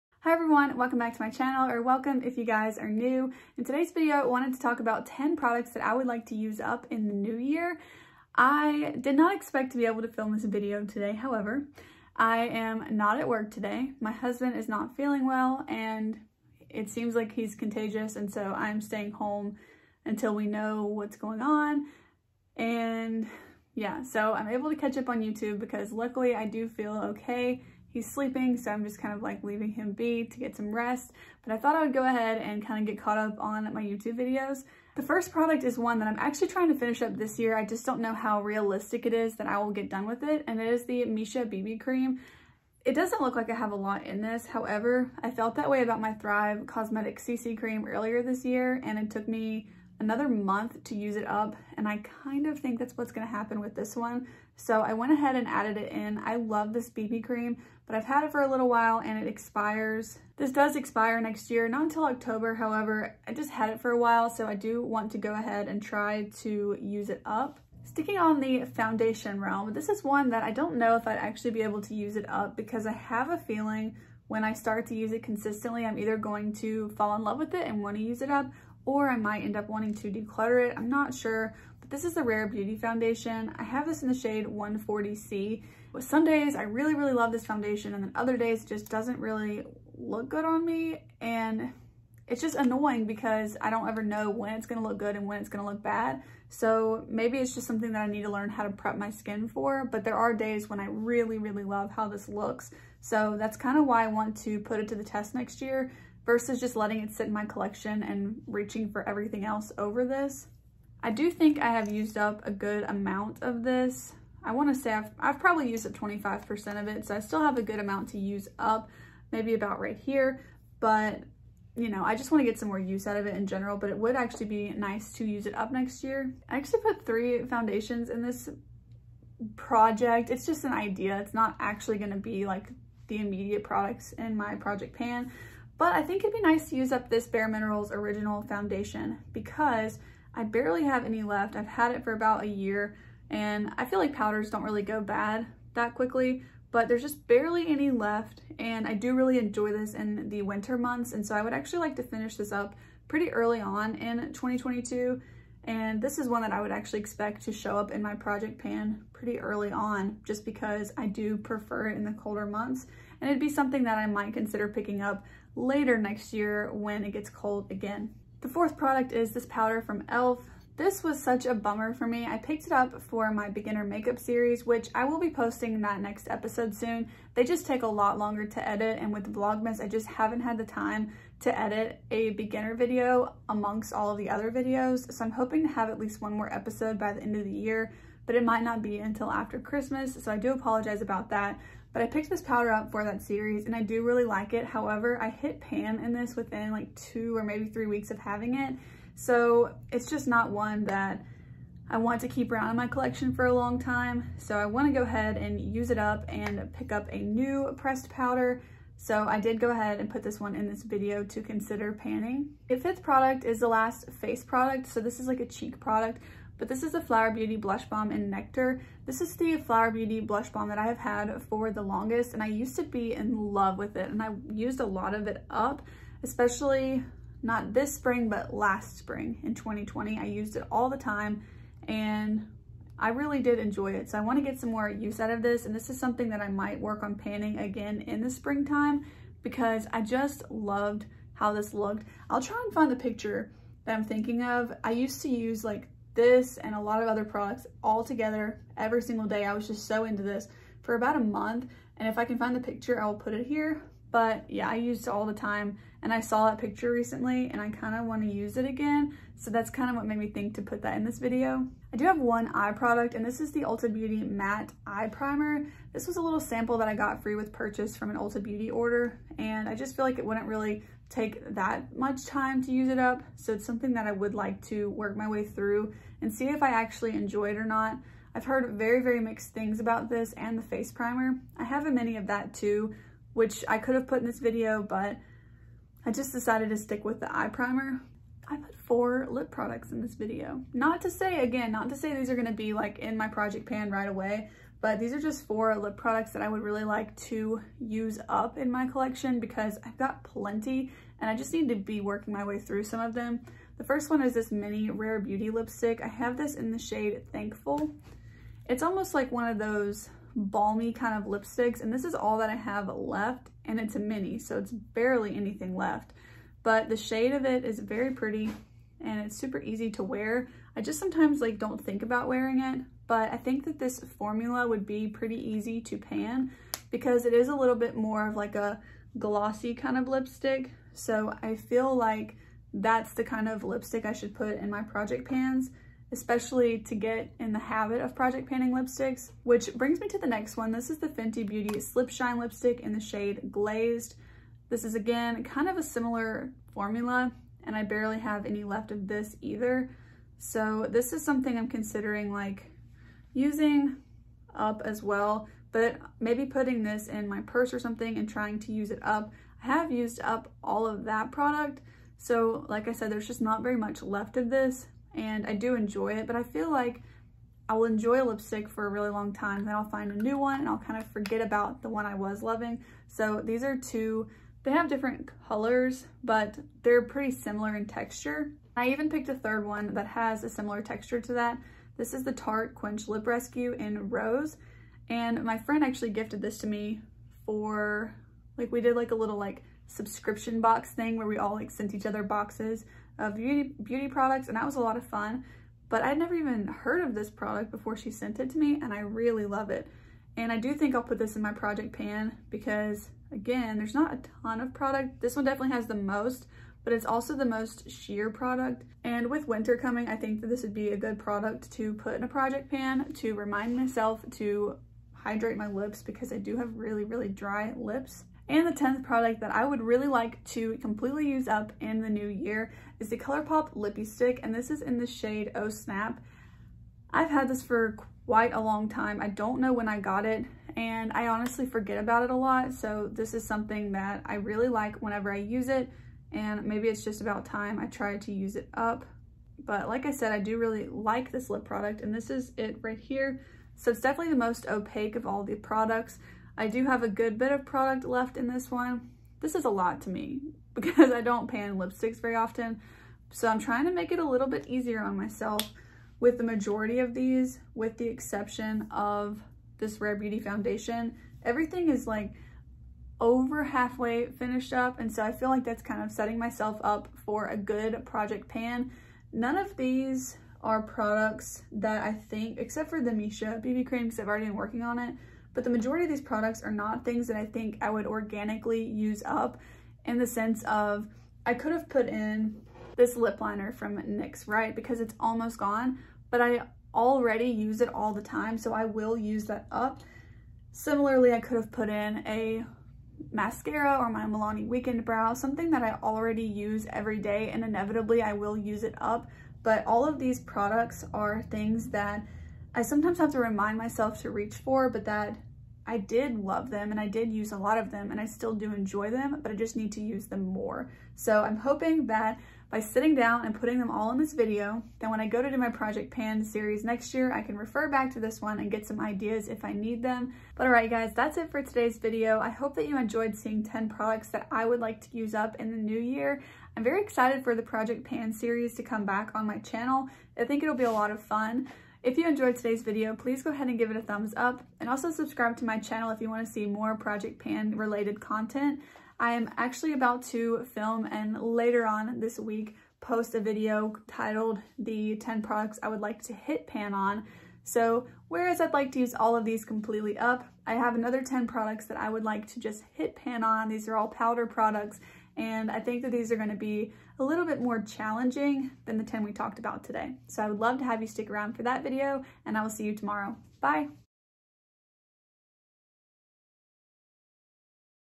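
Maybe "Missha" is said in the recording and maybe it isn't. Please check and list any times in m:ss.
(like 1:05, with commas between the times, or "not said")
0:41, 7:53.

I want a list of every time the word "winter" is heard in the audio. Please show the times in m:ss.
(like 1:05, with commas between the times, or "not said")
2:30, 6:49.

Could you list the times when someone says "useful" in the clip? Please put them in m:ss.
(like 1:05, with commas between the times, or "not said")
not said.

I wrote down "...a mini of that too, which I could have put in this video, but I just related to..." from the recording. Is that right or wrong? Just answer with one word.
wrong.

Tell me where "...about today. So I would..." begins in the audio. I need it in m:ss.
9:19.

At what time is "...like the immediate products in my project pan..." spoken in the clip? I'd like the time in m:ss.
2:12.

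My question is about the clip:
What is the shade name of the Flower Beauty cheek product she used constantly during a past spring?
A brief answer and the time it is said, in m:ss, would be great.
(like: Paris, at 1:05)
Nectar, at 3:38.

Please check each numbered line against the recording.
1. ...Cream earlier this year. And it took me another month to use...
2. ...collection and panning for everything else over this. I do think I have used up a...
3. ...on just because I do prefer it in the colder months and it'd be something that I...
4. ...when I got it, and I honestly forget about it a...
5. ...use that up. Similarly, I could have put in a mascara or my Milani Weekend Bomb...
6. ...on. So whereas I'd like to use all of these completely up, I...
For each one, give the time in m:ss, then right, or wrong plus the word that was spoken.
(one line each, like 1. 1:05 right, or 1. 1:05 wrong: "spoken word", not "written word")
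1. 0:47 right
2. 1:47 wrong: "reaching", not "panning"
3. 2:39 right
4. 7:09 right
5. 8:09 wrong: "Brow", not "Bomb"
6. 9:06 right.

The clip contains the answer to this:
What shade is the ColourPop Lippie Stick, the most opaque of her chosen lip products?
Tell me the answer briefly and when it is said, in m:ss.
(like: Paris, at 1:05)
Oh Snap, at 7:05.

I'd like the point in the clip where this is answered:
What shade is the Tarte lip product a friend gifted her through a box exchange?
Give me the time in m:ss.
6:24.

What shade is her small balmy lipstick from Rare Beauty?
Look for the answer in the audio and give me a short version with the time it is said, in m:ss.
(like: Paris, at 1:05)
Thankful, at 5:07.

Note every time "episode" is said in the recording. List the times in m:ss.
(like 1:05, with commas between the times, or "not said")
2:56, 3:06.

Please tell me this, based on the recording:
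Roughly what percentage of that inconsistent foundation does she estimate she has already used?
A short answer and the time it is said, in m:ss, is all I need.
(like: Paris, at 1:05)
25%, at 1:55.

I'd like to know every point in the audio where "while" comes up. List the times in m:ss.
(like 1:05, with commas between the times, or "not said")
0:58, 1:03.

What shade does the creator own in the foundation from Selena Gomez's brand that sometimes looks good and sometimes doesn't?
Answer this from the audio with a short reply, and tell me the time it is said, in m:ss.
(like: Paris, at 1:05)
140C, at 1:24.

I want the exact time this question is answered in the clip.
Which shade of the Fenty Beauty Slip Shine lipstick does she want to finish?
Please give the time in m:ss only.
5:43.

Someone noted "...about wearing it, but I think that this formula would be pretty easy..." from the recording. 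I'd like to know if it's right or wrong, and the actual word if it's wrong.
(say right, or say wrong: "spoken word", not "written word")
right.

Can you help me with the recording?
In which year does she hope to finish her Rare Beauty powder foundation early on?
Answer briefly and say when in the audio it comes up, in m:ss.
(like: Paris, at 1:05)
2022, at 2:34.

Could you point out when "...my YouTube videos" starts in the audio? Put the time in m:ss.
0:33.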